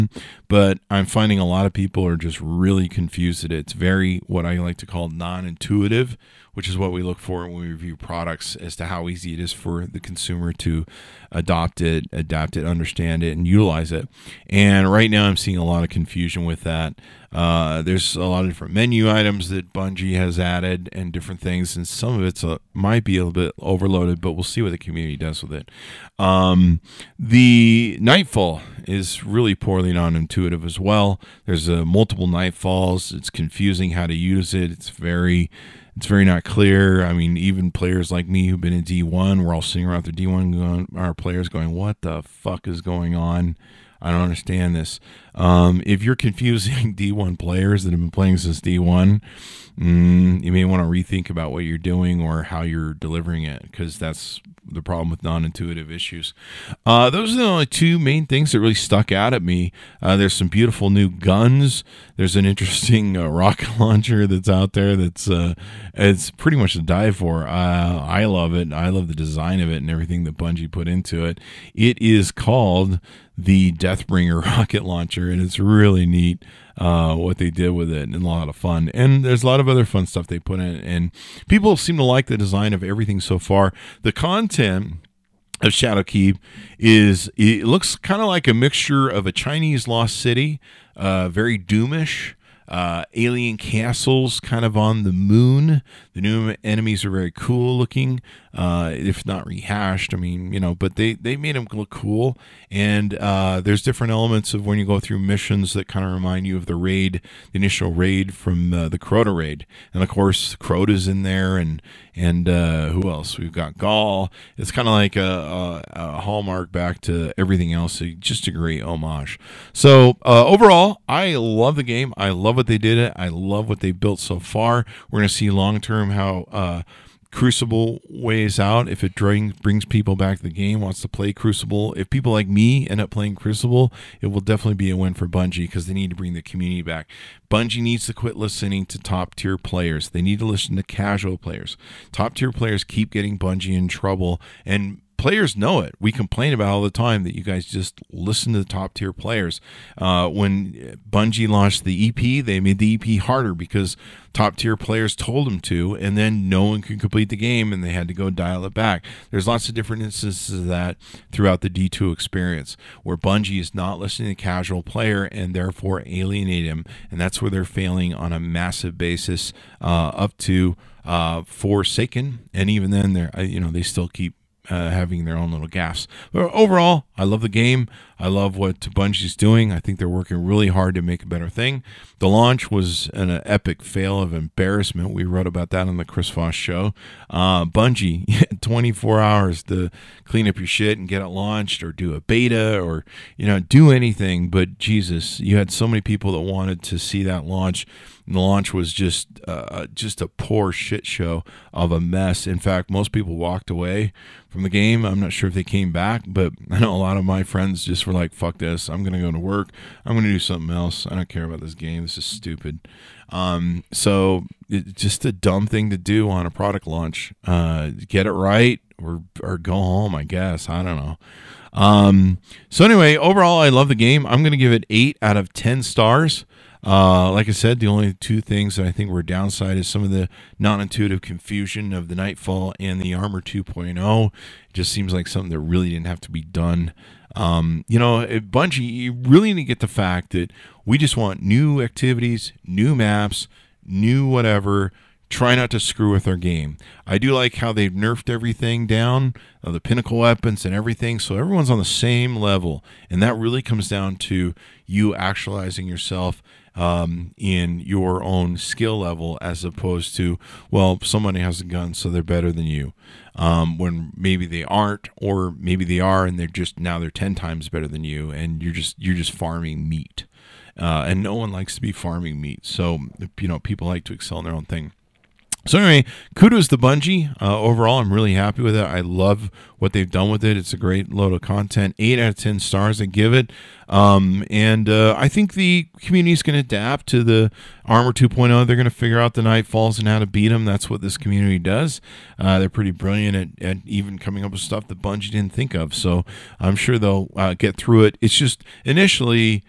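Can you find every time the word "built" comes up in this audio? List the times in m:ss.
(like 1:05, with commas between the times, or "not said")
2:03.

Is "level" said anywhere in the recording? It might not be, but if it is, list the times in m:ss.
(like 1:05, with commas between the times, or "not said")
4:12, 4:18.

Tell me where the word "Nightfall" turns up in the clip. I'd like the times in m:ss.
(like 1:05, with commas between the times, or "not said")
0:27, 0:32, 3:52, 4:49.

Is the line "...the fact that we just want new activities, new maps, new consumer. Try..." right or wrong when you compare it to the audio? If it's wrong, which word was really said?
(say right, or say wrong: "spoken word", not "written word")
wrong: "whatever", not "consumer".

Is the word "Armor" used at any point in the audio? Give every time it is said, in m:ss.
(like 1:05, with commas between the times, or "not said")
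3:53, 4:47.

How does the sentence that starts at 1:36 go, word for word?
The new enemies are very cool looking, uh, if not rehashed.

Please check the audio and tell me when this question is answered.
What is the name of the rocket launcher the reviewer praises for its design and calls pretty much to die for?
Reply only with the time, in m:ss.
1:13.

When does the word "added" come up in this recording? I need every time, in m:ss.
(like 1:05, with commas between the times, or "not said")
0:20.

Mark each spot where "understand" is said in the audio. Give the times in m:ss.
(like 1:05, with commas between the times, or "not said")
0:12, 0:44.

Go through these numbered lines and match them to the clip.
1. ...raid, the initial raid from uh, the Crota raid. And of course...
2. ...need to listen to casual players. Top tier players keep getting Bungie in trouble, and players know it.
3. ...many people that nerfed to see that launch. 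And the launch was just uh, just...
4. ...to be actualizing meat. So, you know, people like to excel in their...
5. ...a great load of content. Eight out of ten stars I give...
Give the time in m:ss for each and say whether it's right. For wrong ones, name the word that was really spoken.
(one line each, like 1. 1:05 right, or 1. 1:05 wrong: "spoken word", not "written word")
1. 1:46 right
2. 2:20 right
3. 3:15 wrong: "wanted", not "nerfed"
4. 4:31 wrong: "farming", not "actualizing"
5. 4:40 right.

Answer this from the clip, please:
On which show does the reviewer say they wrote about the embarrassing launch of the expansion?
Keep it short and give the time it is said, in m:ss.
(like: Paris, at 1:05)
The Chris Voss Show, at 3:06.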